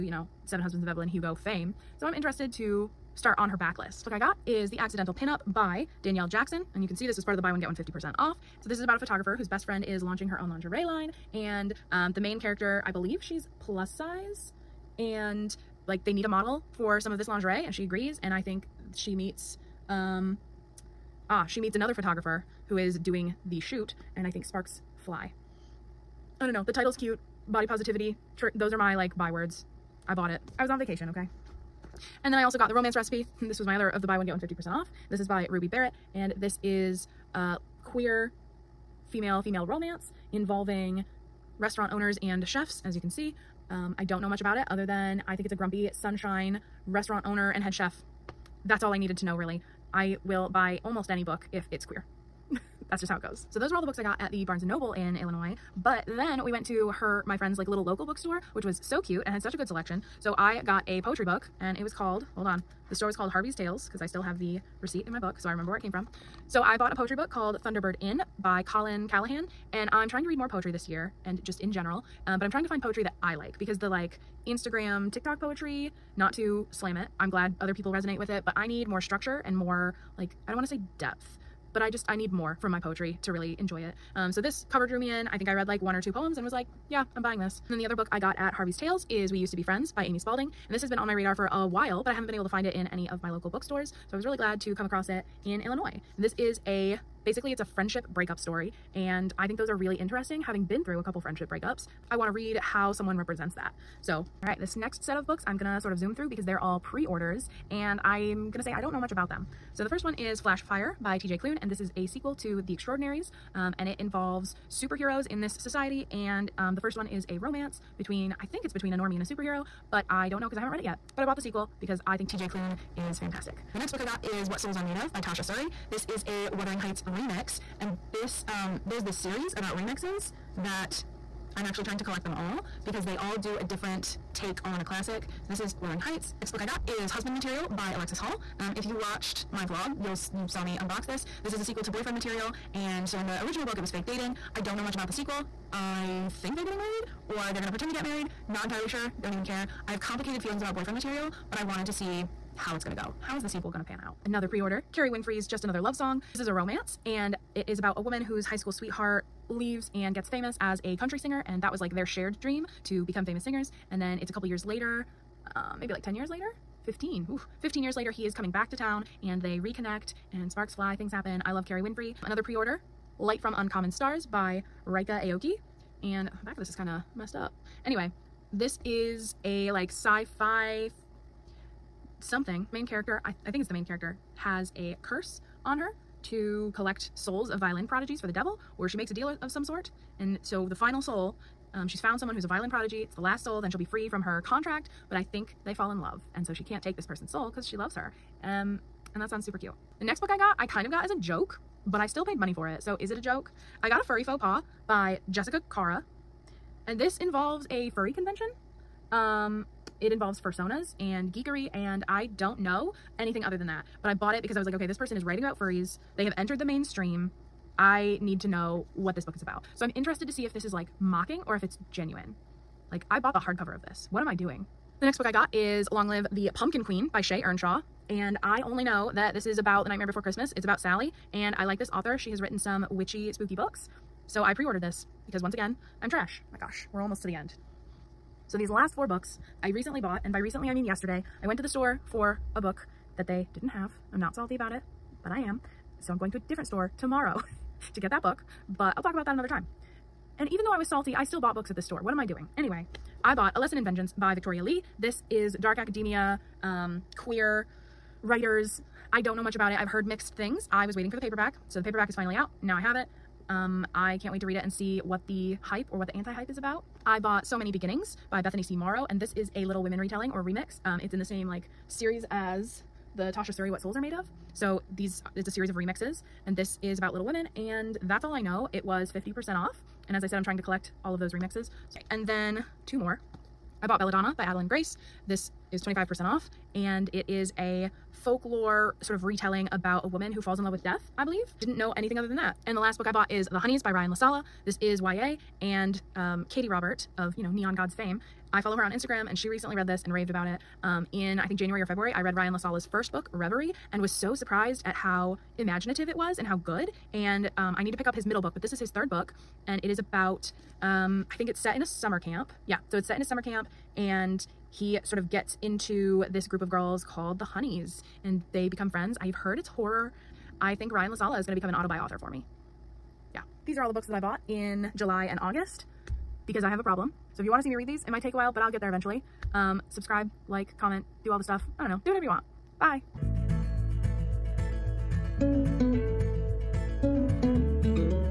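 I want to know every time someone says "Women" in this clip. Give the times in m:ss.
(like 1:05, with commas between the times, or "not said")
4:29, 4:37.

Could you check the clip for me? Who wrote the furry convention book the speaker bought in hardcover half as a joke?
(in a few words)
Jessica Kara.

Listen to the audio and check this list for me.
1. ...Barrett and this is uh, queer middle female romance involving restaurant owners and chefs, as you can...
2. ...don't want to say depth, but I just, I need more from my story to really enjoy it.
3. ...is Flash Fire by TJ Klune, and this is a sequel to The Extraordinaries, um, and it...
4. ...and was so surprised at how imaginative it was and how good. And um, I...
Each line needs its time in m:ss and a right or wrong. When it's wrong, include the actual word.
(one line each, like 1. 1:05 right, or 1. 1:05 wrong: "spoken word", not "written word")
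1. 0:35 wrong: "female", not "middle"
2. 1:20 wrong: "poetry", not "story"
3. 1:50 right
4. 5:03 right.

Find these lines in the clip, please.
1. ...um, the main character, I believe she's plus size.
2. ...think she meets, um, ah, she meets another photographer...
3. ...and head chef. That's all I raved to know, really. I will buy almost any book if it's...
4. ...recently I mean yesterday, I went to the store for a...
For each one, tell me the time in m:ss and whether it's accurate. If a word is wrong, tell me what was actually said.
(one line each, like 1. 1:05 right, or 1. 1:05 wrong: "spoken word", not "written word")
1. 0:11 right
2. 0:18 right
3. 0:47 wrong: "needed", not "raved"
4. 4:00 right.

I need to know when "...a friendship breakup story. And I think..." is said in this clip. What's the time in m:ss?
1:37.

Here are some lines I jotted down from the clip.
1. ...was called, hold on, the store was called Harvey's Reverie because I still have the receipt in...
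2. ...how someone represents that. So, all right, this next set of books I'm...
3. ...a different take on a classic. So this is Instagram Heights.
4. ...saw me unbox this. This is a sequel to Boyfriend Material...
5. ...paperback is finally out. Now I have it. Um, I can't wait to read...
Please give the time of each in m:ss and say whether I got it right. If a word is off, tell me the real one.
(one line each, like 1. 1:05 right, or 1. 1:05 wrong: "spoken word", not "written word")
1. 1:01 wrong: "Tales", not "Reverie"
2. 1:42 right
3. 2:13 wrong: "Wuthering", not "Instagram"
4. 2:20 right
5. 4:21 right.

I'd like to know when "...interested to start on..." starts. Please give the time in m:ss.
0:02.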